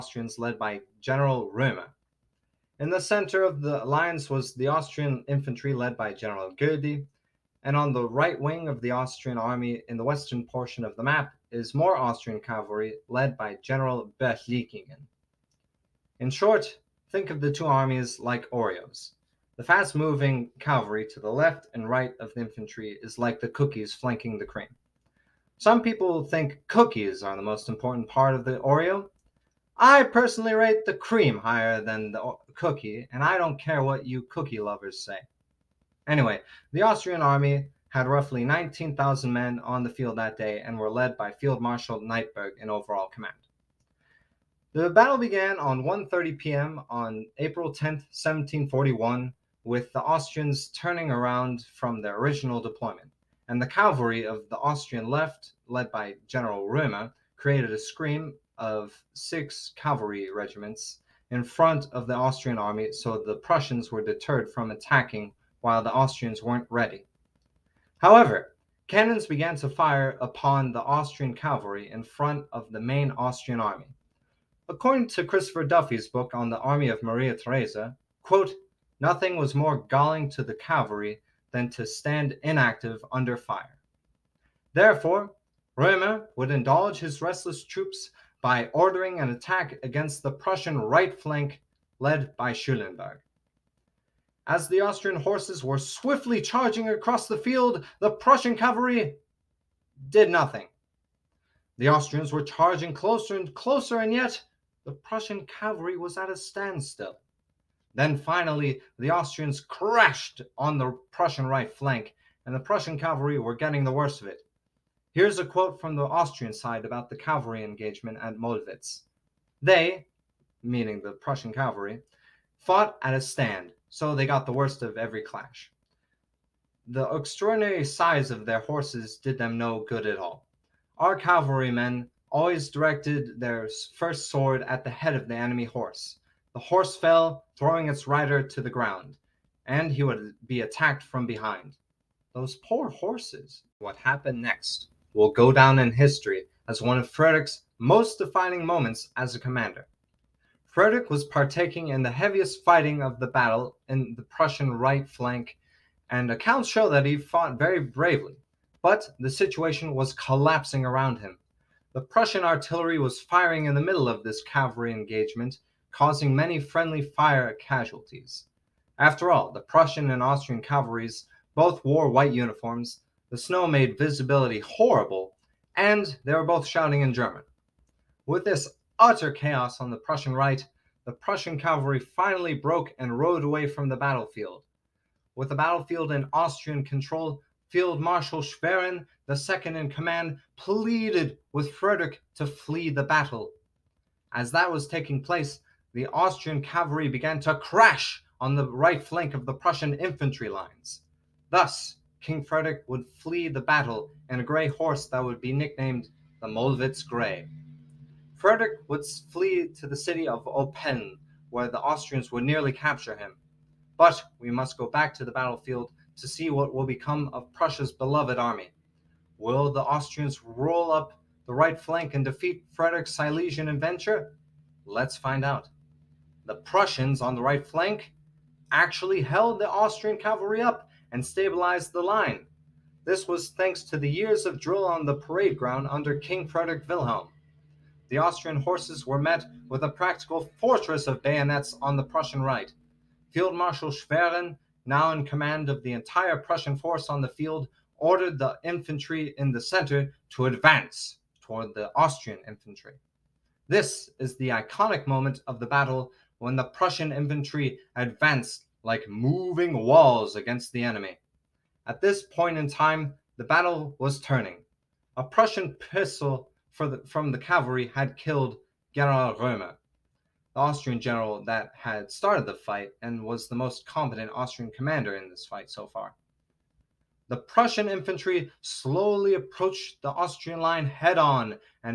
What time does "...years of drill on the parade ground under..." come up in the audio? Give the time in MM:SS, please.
03:54.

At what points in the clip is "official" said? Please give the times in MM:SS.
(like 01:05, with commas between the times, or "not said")
not said.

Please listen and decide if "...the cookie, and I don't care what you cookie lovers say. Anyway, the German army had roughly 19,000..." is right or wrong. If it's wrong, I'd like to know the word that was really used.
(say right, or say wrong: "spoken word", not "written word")
wrong: "Austrian", not "German".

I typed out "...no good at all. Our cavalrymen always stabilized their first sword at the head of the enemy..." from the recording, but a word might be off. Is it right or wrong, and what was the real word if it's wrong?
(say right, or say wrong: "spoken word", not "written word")
wrong: "directed", not "stabilized".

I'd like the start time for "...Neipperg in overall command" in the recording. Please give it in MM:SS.
00:41.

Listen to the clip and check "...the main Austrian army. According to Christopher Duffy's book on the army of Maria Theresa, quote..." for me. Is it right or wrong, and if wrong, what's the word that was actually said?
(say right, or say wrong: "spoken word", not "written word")
right.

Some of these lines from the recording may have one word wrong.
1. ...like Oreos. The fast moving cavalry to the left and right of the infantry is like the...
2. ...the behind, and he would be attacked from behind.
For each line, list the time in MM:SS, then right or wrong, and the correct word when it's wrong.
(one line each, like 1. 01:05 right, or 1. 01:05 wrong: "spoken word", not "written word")
1. 00:18 right
2. 02:18 wrong: "ground", not "behind".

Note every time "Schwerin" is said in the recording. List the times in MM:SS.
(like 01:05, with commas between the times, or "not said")
03:08, 04:03.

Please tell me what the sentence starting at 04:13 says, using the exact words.
This is the iconic moment of the battle when the Prussian infantry advanced like moving walls against the enemy.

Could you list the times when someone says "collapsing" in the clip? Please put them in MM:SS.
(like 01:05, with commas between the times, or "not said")
02:40.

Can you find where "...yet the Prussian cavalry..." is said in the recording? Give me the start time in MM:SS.
01:44.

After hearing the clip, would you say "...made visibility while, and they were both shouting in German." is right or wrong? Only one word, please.
wrong.